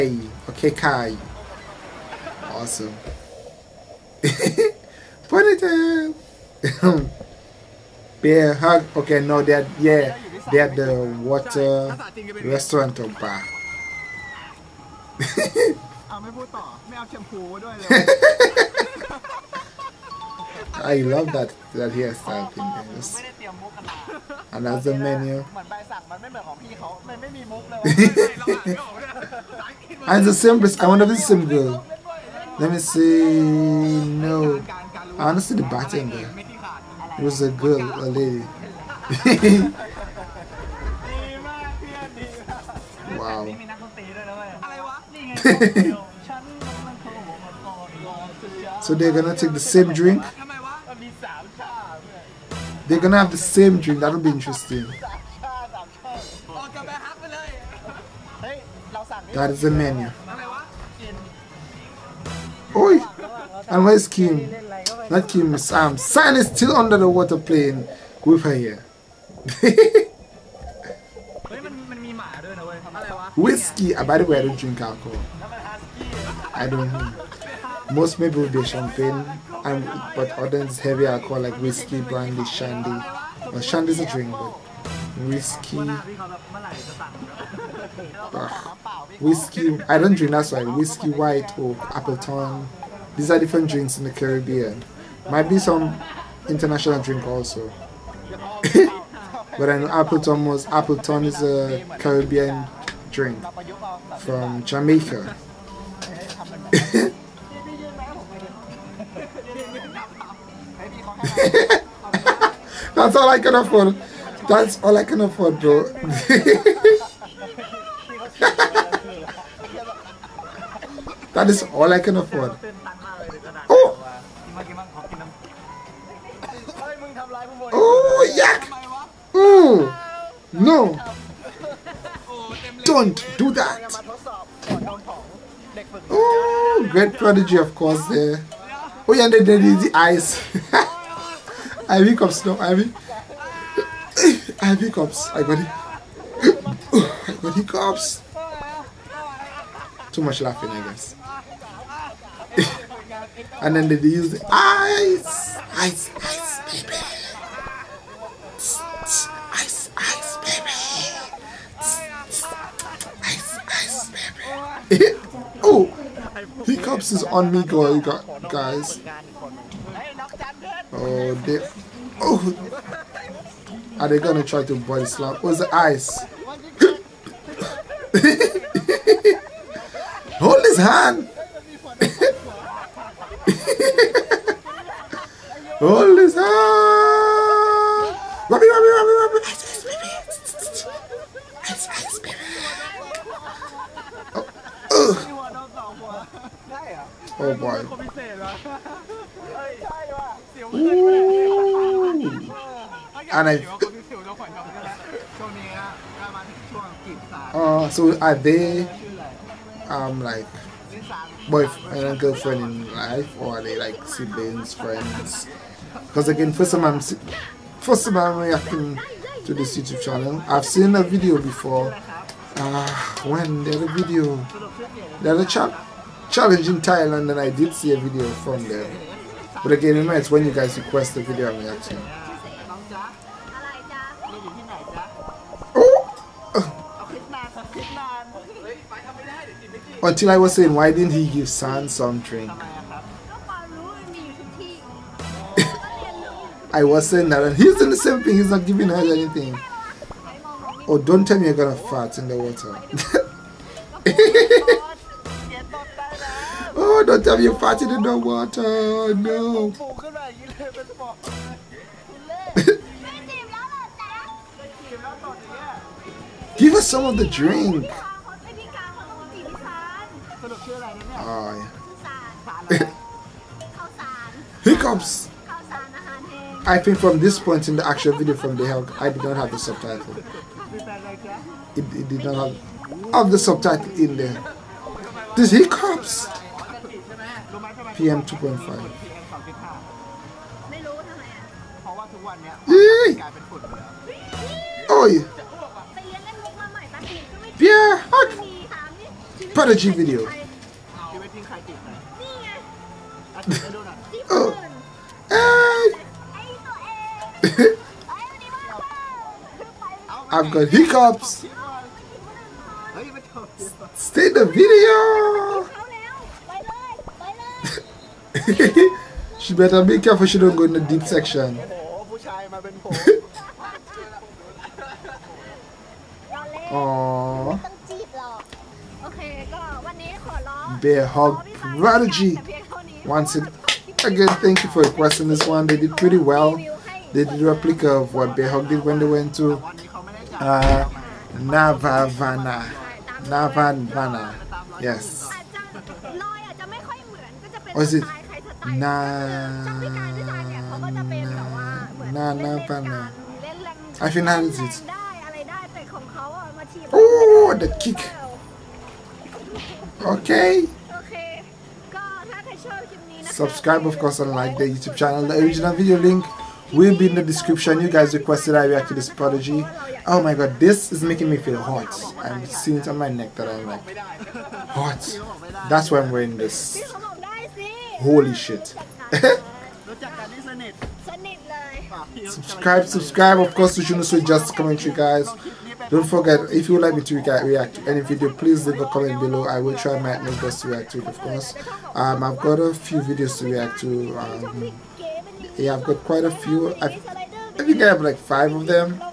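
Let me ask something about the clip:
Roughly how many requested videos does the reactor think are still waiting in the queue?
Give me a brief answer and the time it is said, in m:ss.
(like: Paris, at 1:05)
5, at 6:38.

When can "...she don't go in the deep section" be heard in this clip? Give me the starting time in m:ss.
5:20.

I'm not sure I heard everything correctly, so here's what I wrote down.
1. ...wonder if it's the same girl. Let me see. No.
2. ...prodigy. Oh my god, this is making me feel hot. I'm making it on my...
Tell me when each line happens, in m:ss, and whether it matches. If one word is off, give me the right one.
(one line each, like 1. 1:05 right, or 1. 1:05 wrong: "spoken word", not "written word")
1. 0:30 right
2. 6:09 wrong: "seeing", not "making".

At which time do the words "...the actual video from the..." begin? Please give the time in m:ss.
4:37.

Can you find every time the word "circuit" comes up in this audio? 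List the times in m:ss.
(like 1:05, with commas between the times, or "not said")
not said.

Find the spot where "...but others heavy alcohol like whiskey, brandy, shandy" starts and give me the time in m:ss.
1:20.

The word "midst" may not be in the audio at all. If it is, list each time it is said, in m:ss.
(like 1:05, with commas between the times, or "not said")
not said.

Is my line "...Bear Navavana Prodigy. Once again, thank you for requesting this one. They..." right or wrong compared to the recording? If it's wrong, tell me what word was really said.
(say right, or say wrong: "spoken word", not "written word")
wrong: "Hug", not "Navavana".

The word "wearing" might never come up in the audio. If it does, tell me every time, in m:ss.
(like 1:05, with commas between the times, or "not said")
6:16.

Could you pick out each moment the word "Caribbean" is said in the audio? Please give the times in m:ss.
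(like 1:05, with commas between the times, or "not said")
1:34, 1:41.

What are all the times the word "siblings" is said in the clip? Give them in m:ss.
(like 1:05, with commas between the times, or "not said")
3:34.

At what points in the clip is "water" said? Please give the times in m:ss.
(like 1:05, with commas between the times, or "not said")
0:11, 1:07, 4:12, 4:18.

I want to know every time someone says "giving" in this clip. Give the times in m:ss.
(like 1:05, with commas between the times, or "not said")
4:08.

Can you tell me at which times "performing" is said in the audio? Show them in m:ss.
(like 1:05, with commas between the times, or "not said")
not said.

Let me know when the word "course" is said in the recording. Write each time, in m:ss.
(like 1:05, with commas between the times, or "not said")
2:17, 6:03, 6:23, 6:31.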